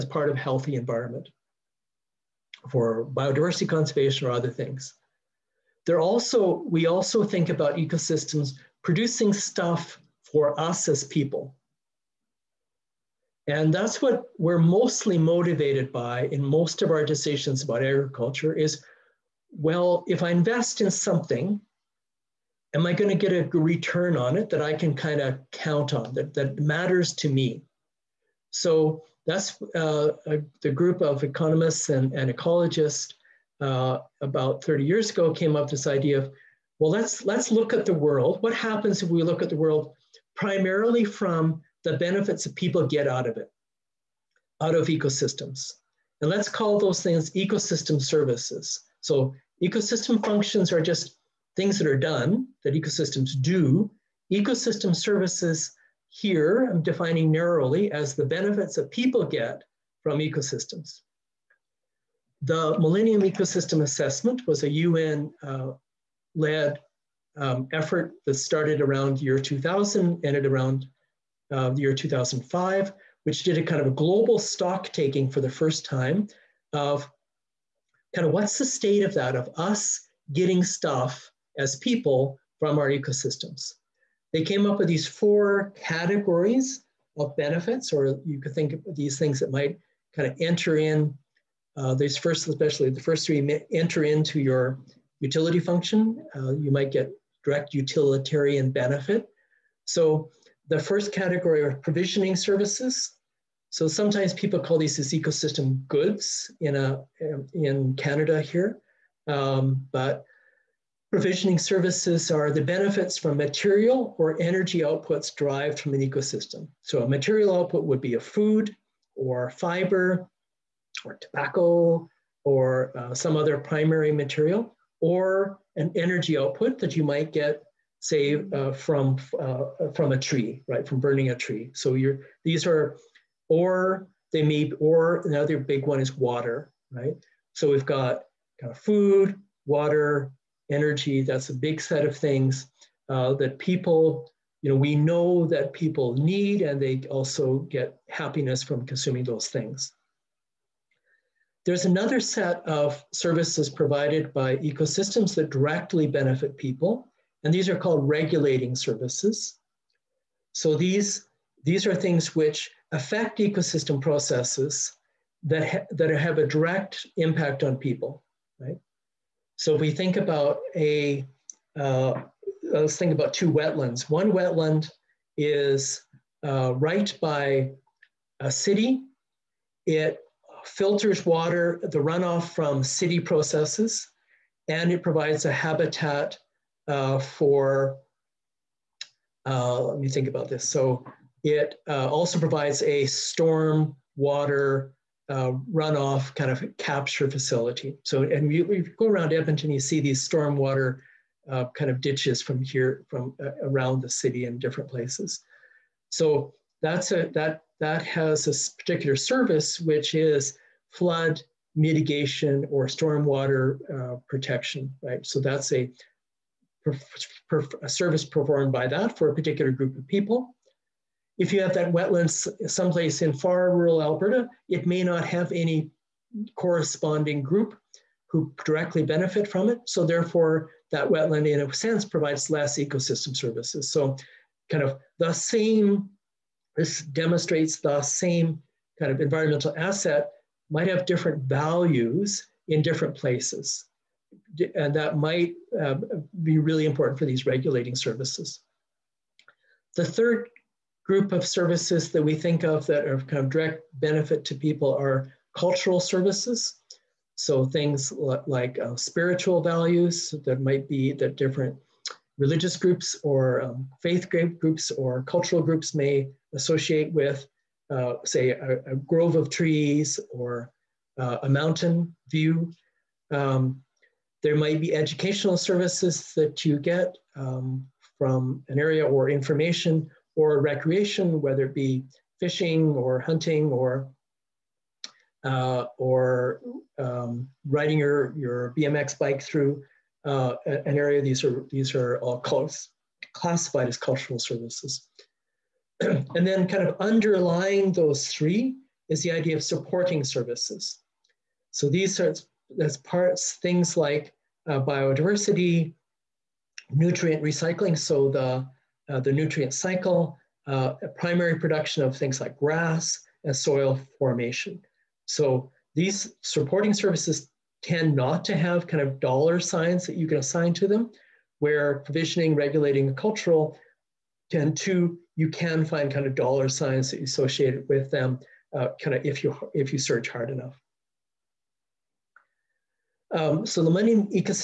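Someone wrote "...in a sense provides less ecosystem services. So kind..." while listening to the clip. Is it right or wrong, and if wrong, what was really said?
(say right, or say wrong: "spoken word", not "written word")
right.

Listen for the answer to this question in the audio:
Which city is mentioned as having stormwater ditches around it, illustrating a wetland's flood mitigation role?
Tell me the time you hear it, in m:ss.
3:19.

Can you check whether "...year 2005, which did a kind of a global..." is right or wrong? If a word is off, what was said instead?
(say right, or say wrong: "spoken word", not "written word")
right.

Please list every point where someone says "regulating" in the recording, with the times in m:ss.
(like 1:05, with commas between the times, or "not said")
2:38, 4:07, 5:22.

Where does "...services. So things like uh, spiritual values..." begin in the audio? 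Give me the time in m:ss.
4:16.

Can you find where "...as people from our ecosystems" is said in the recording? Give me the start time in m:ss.
1:21.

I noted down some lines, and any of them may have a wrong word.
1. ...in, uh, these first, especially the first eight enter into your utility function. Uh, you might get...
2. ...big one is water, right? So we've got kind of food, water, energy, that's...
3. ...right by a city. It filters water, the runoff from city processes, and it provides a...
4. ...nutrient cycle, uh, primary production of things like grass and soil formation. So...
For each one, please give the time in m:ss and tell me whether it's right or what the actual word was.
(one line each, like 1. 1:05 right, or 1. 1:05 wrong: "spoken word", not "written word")
1. 1:30 wrong: "three", not "eight"
2. 2:15 right
3. 2:56 right
4. 5:09 right.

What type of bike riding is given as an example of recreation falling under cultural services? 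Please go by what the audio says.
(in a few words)
BMX.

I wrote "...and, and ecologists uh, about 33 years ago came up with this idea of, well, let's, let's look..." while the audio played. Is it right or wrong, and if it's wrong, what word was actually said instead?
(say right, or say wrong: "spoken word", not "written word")
wrong: "30", not "33".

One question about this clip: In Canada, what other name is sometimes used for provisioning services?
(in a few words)
ecosystem goods.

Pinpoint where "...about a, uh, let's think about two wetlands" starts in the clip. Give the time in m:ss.
2:50.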